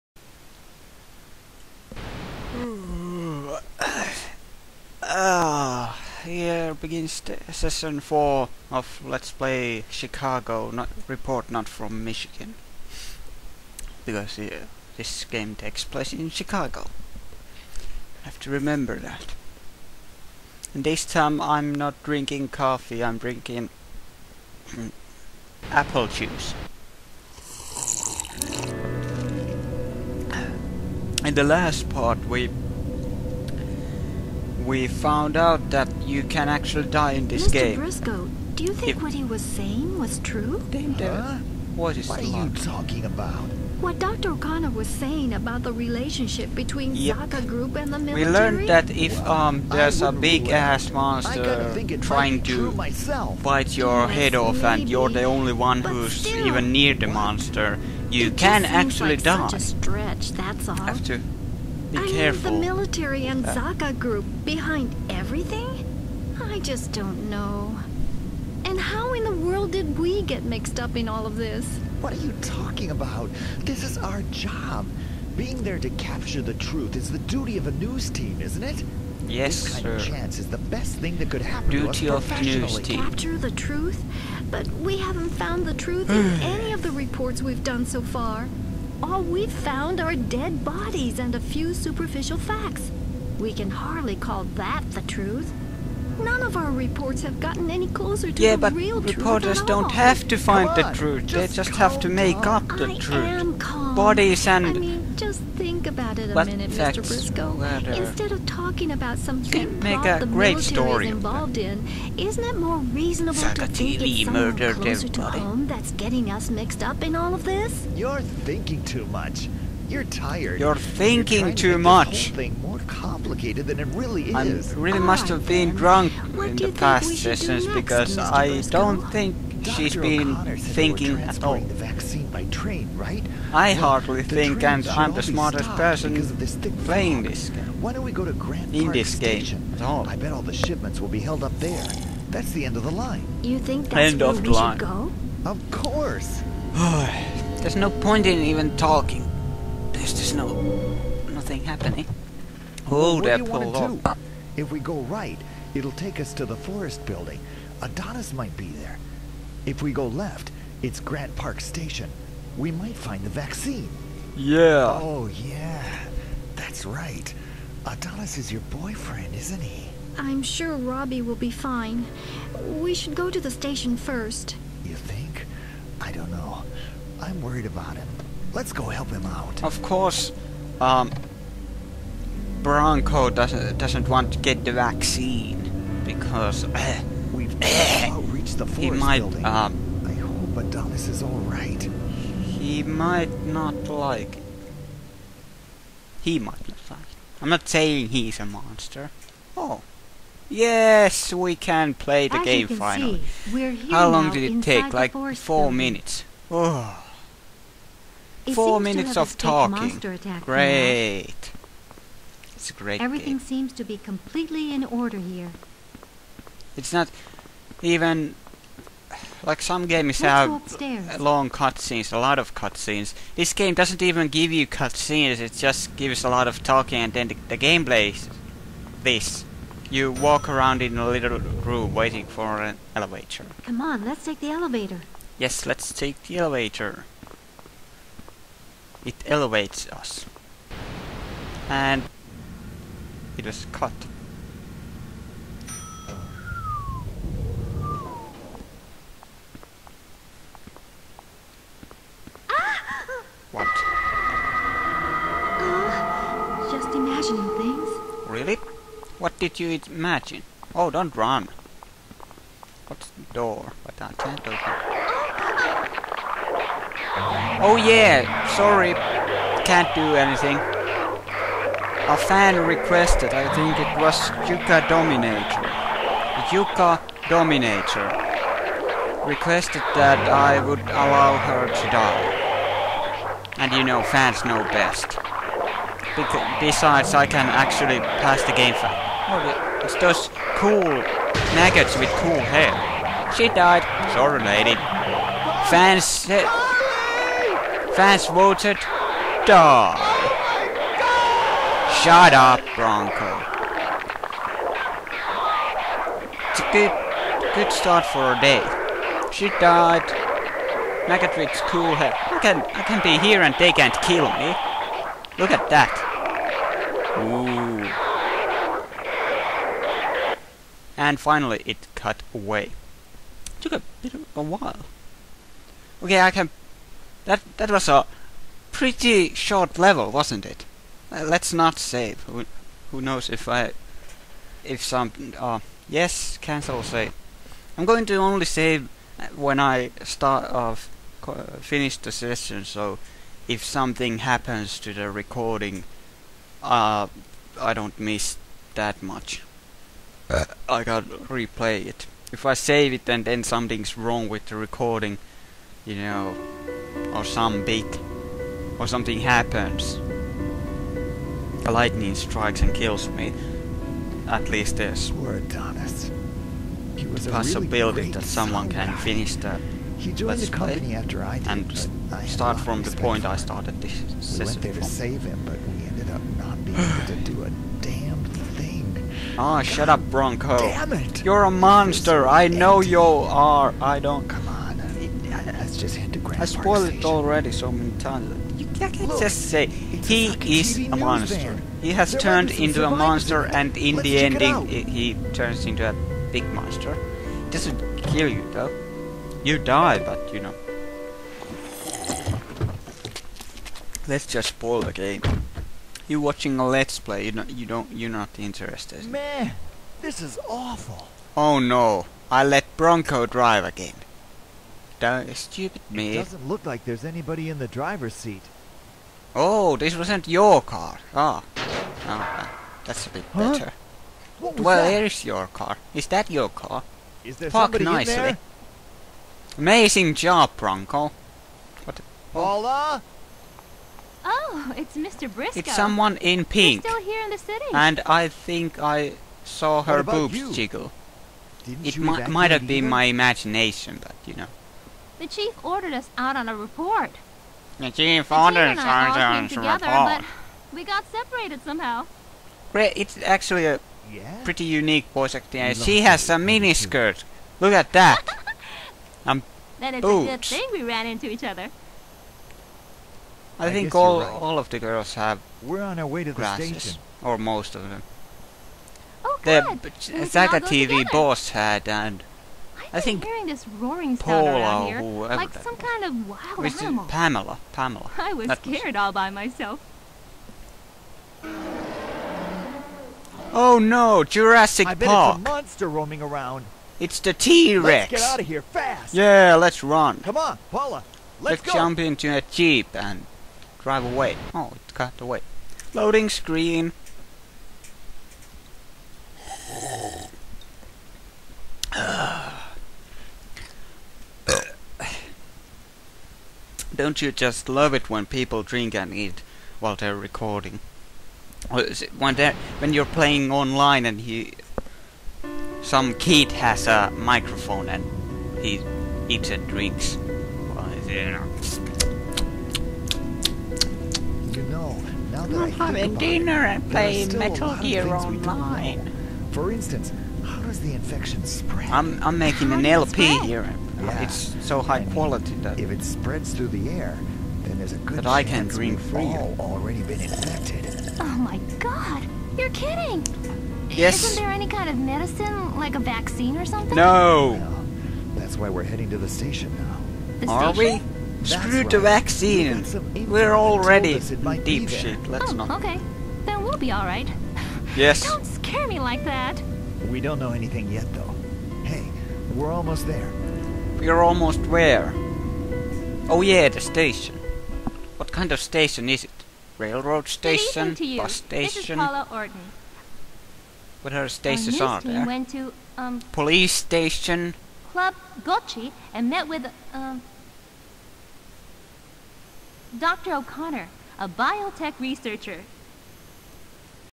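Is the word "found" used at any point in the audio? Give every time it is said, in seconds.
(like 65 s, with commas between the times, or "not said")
34 s, 85 s, 89 s.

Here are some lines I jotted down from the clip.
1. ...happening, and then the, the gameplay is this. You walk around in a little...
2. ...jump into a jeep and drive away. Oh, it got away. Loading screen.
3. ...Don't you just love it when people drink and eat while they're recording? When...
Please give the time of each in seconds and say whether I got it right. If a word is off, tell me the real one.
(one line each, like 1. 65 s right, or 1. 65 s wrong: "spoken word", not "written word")
1. 226 s wrong: "talking", not "happening"
2. 491 s right
3. 506 s right.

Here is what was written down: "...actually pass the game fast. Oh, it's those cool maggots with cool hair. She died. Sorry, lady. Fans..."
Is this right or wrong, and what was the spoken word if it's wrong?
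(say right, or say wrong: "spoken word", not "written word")
right.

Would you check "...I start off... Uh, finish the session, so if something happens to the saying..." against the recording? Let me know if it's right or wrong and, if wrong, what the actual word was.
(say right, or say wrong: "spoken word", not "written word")
wrong: "recording", not "saying".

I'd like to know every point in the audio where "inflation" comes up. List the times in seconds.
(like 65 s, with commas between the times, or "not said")
not said.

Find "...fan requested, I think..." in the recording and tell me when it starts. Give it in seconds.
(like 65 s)
272 s.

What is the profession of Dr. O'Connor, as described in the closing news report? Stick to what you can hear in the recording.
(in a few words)
biotech researcher.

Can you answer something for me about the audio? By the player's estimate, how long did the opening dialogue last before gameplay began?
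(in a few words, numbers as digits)
four minutes.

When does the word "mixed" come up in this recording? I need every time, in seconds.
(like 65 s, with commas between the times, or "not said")
70 s, 116 s.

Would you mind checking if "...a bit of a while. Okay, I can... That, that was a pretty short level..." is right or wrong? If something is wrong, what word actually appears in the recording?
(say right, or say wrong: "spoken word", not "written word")
right.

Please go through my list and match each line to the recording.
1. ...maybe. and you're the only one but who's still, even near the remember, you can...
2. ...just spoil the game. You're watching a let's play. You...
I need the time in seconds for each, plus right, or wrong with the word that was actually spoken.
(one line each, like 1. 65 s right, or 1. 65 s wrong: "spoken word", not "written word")
1. 54 s wrong: "monster", not "remember"
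2. 404 s right.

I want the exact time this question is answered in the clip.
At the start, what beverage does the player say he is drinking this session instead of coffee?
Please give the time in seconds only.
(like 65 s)
25 s.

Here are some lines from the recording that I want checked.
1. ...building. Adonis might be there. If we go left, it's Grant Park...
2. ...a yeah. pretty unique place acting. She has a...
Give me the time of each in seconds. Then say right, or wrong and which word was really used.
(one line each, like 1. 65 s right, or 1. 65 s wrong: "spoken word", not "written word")
1. 157 s right
2. 453 s wrong: "voice", not "place".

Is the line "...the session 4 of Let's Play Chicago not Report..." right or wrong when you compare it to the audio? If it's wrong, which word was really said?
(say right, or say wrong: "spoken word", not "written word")
right.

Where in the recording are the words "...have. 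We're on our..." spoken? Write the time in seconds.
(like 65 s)
465 s.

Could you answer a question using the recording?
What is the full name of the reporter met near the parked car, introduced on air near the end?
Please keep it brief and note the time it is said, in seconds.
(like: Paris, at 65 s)
Paula Orton, at 571 s.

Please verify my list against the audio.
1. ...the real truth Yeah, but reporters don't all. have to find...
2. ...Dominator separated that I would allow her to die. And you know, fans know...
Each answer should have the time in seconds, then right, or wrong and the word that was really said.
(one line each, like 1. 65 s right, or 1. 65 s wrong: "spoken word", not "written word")
1. 98 s right
2. 277 s wrong: "requested", not "separated".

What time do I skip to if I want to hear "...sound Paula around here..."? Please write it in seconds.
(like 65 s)
474 s.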